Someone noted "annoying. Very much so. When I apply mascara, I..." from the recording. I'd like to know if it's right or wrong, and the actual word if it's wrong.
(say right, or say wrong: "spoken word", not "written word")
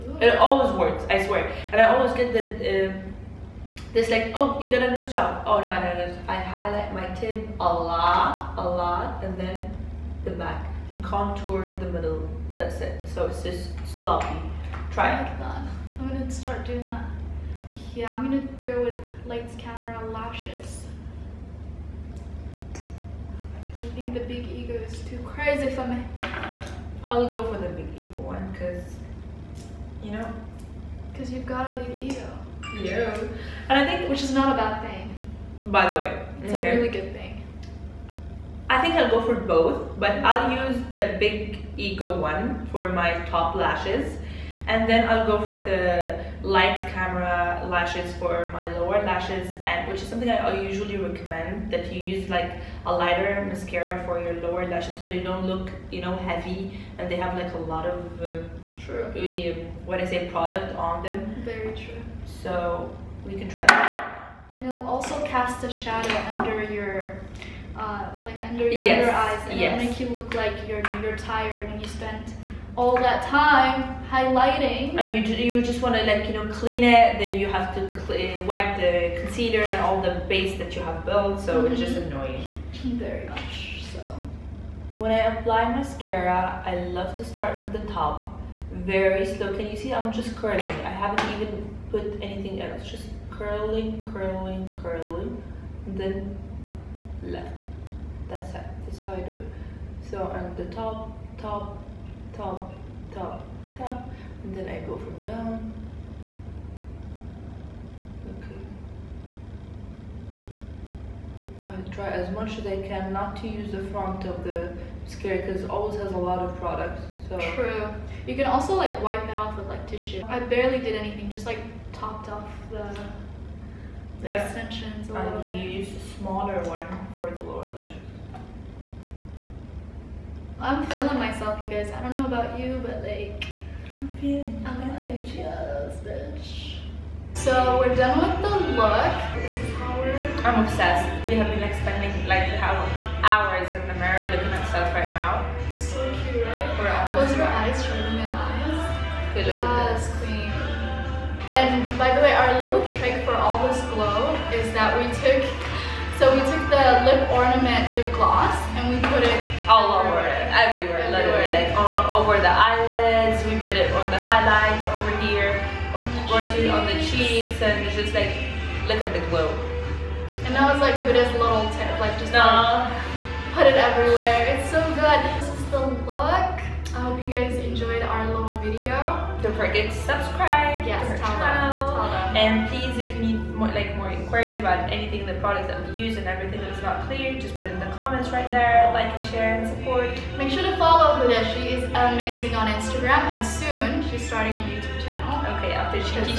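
right.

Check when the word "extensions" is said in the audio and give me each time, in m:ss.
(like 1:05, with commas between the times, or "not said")
2:04.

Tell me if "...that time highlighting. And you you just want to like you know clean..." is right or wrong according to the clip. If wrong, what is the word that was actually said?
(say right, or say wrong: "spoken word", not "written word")
right.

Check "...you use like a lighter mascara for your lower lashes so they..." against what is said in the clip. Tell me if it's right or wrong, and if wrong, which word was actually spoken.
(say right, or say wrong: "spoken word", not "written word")
right.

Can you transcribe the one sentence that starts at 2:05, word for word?
use a smaller one for the lower lashes.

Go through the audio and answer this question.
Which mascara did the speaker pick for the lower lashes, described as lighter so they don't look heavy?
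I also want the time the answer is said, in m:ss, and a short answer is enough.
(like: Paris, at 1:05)
Lights, Camera, Lashes, at 0:46.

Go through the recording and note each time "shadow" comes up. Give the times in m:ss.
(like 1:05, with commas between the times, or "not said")
1:05.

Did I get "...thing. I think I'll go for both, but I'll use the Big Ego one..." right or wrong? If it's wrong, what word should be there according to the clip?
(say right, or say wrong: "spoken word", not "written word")
right.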